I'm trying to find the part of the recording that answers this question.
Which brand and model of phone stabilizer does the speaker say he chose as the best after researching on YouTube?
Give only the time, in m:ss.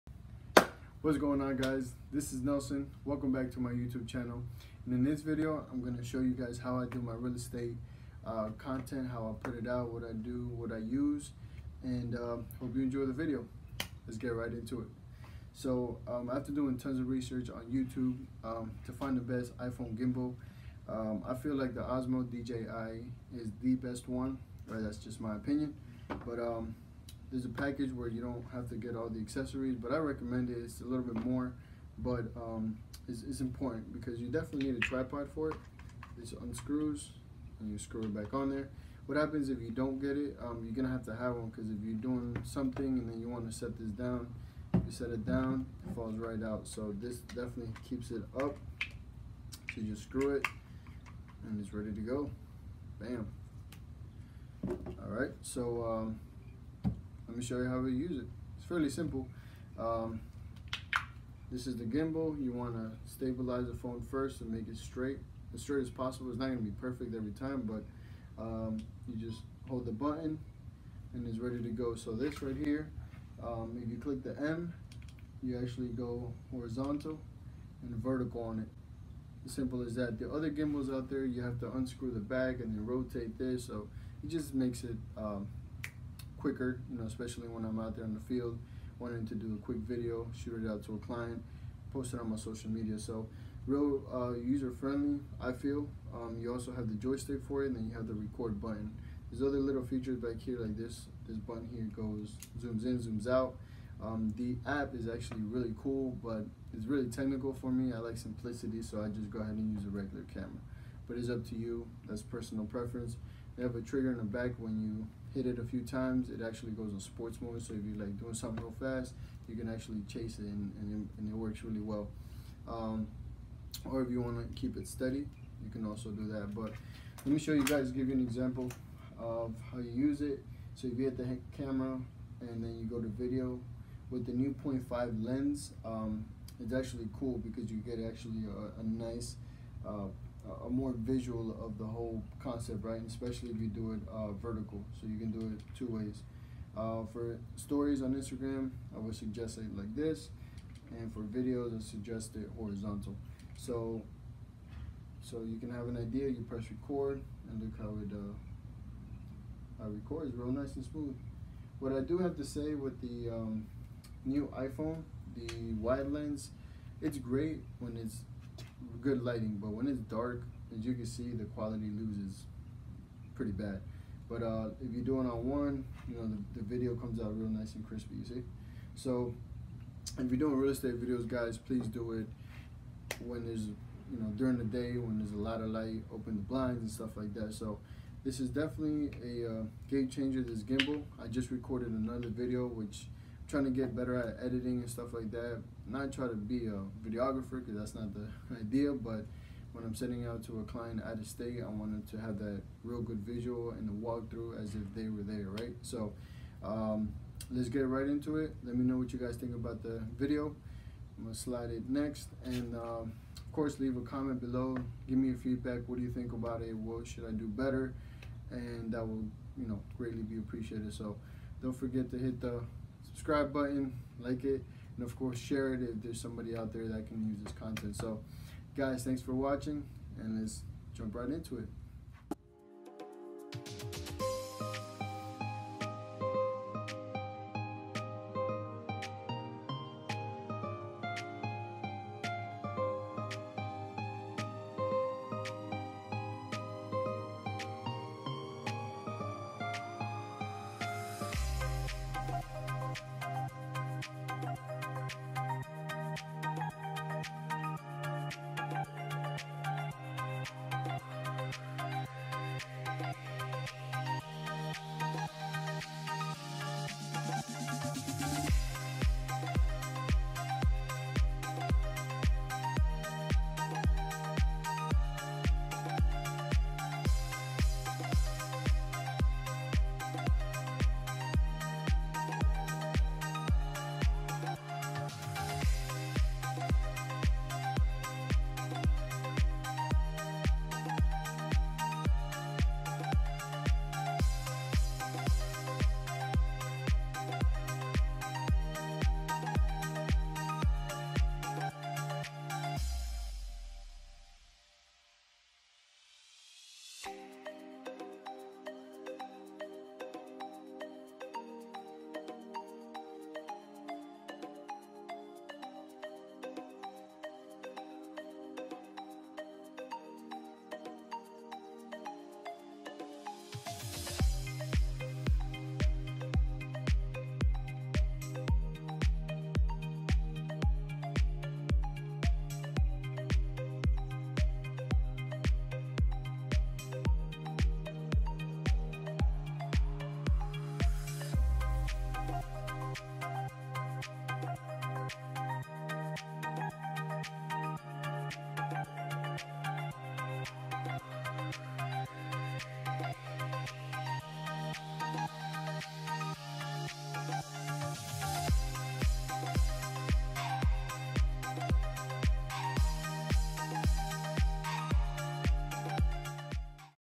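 0:21.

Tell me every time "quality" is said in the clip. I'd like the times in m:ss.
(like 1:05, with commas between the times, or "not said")
2:51.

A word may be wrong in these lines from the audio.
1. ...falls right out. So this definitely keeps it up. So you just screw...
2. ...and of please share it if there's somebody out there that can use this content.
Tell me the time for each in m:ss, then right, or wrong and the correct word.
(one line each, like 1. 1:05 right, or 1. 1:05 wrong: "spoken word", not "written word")
1. 0:45 right
2. 3:44 wrong: "course", not "please".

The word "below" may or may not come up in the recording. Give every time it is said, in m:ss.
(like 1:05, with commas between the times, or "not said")
3:34.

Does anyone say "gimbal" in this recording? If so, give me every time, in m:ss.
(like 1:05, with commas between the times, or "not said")
0:19, 1:01, 1:20, 3:10.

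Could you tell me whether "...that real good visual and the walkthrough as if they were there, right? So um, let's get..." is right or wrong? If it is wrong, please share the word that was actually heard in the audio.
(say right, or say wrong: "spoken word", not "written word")
right.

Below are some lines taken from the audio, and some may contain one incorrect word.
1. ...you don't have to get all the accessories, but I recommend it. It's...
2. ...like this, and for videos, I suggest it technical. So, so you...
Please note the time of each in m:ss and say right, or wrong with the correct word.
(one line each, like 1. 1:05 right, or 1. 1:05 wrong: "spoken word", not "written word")
1. 0:28 right
2. 2:29 wrong: "horizontal", not "technical".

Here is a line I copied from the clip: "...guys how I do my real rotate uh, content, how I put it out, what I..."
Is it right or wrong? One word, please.
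wrong.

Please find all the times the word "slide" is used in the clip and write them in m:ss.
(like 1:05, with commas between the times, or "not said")
3:31.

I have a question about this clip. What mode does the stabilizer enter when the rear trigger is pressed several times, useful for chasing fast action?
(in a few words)
sports mode.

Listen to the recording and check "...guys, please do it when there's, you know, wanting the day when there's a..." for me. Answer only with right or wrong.
wrong.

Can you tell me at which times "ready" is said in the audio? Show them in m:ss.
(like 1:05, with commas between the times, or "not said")
0:51, 1:11.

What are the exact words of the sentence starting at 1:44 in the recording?
Um, the app is actually really cool, but it's really technical for me.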